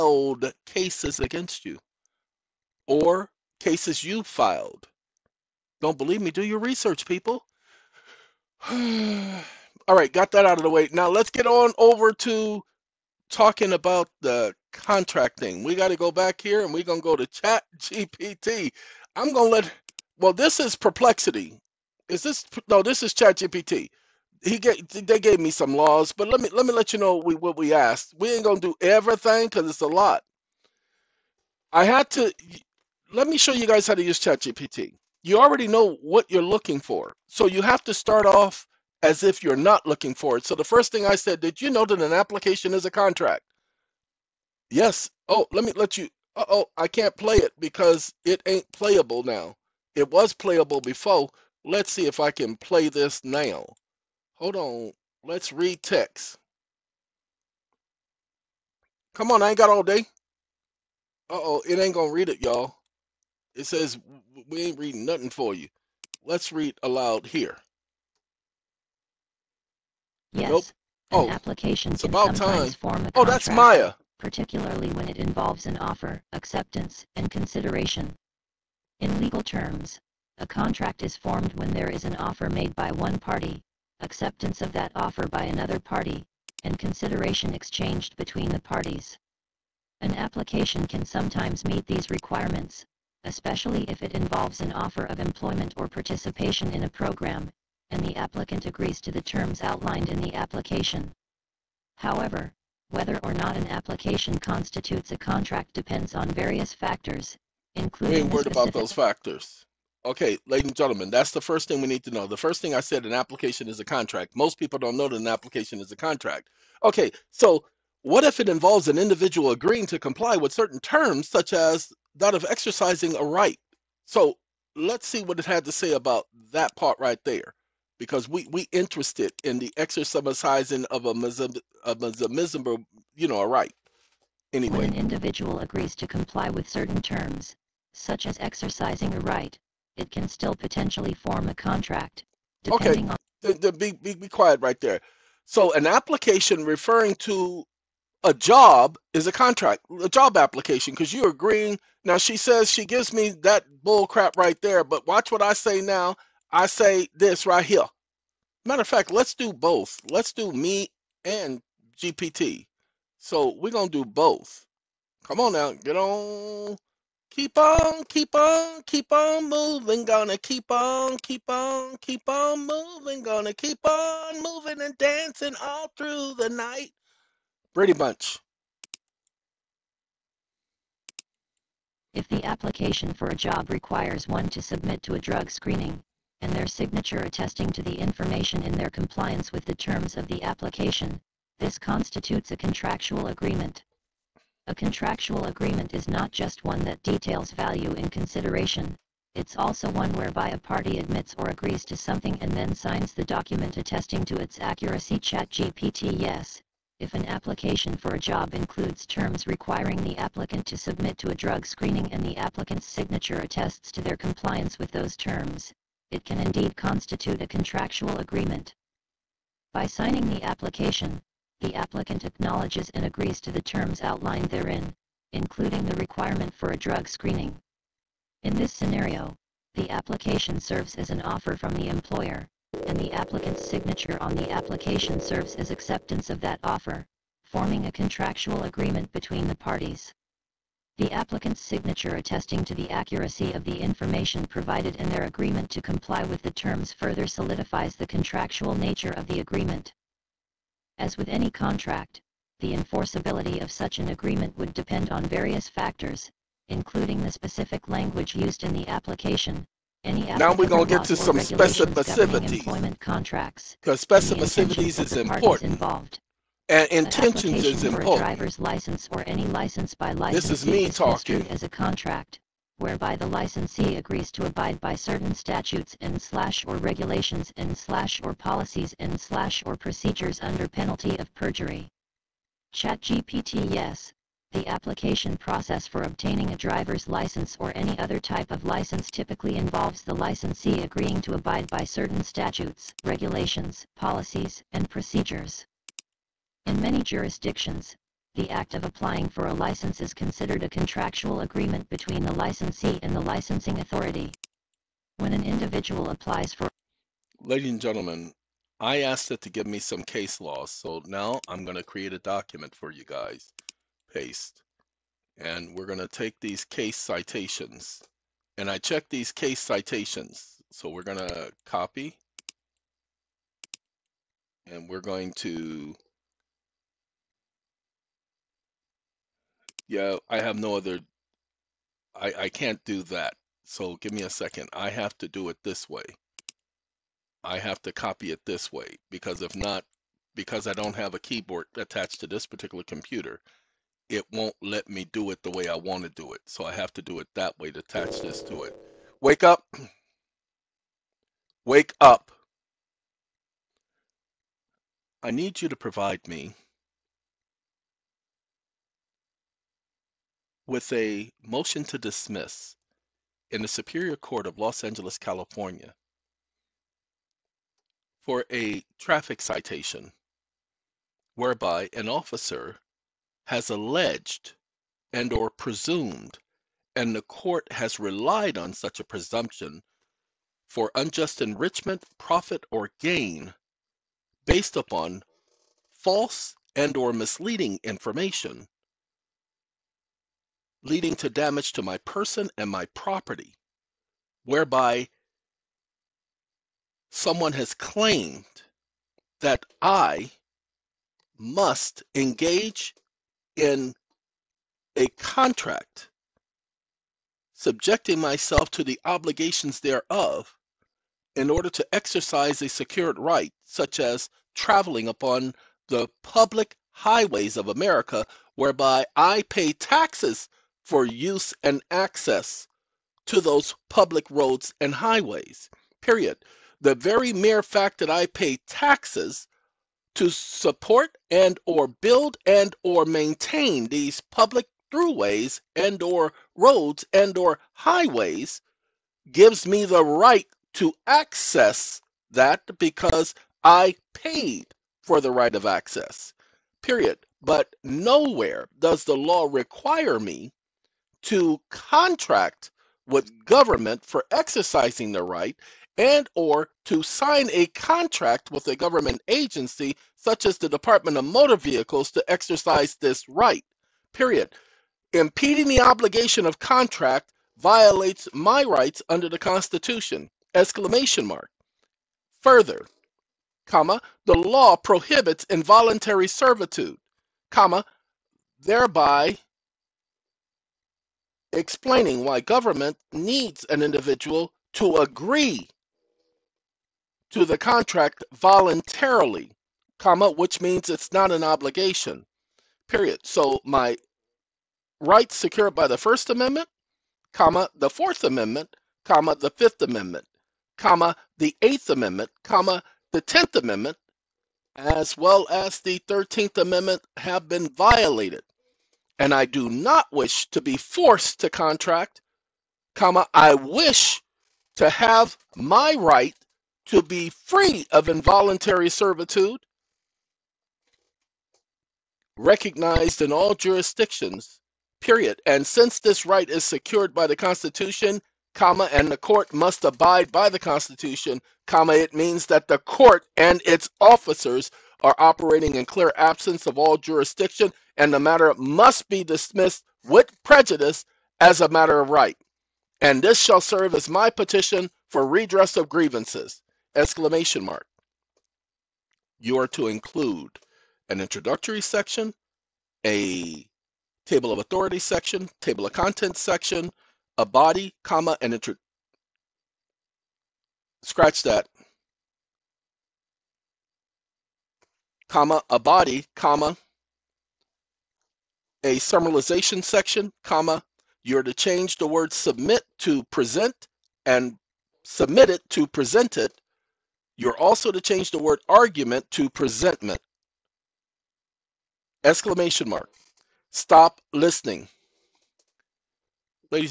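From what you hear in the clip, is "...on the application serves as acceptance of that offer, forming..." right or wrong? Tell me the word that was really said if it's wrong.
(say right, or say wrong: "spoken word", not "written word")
right.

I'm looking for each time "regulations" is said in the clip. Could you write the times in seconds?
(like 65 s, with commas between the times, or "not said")
276 s, 293 s.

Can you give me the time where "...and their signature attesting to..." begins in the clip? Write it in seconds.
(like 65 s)
186 s.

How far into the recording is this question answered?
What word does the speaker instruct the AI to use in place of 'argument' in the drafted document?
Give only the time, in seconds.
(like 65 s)
579 s.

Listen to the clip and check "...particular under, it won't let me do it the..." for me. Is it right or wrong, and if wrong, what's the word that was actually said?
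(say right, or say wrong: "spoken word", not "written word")
wrong: "computer", not "under".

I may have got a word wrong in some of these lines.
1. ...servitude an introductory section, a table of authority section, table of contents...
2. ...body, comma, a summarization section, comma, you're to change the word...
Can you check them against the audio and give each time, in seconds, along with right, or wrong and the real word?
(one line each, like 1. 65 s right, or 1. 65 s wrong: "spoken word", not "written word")
1. 549 s wrong: "include", not "servitude"
2. 565 s right.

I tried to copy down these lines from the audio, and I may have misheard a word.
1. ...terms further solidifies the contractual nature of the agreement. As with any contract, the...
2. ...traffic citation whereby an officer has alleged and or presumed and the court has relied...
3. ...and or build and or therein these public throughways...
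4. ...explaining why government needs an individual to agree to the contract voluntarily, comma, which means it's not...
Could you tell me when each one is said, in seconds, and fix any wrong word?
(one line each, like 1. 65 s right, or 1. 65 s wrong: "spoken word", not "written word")
1. 246 s right
2. 368 s right
3. 431 s wrong: "maintain", not "therein"
4. 481 s right.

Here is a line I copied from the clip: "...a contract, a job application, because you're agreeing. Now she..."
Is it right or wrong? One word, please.
right.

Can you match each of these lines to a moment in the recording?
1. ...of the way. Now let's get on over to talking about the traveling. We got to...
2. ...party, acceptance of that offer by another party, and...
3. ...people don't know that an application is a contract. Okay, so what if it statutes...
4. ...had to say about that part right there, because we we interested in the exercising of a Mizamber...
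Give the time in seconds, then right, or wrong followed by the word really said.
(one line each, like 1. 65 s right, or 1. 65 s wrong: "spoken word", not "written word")
1. 10 s wrong: "contracting", not "traveling"
2. 83 s right
3. 114 s wrong: "involves", not "statutes"
4. 125 s right.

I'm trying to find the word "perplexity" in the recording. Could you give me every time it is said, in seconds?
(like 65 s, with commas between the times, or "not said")
20 s.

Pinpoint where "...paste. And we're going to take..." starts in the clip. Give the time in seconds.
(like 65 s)
314 s.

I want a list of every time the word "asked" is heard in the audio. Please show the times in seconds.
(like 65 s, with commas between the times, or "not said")
27 s, 309 s.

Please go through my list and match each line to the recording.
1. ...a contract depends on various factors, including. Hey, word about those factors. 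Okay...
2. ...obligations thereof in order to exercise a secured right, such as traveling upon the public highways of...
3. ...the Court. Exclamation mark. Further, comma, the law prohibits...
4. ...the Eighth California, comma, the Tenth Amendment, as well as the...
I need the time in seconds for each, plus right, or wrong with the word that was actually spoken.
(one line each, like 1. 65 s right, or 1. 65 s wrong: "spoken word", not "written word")
1. 105 s right
2. 409 s right
3. 469 s wrong: "Constitution", not "Court"
4. 501 s wrong: "Amendment", not "California".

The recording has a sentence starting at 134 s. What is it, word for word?
Anyway, when an individual agrees to comply with certain terms, such as exercising a right, it can still potentially form a contract.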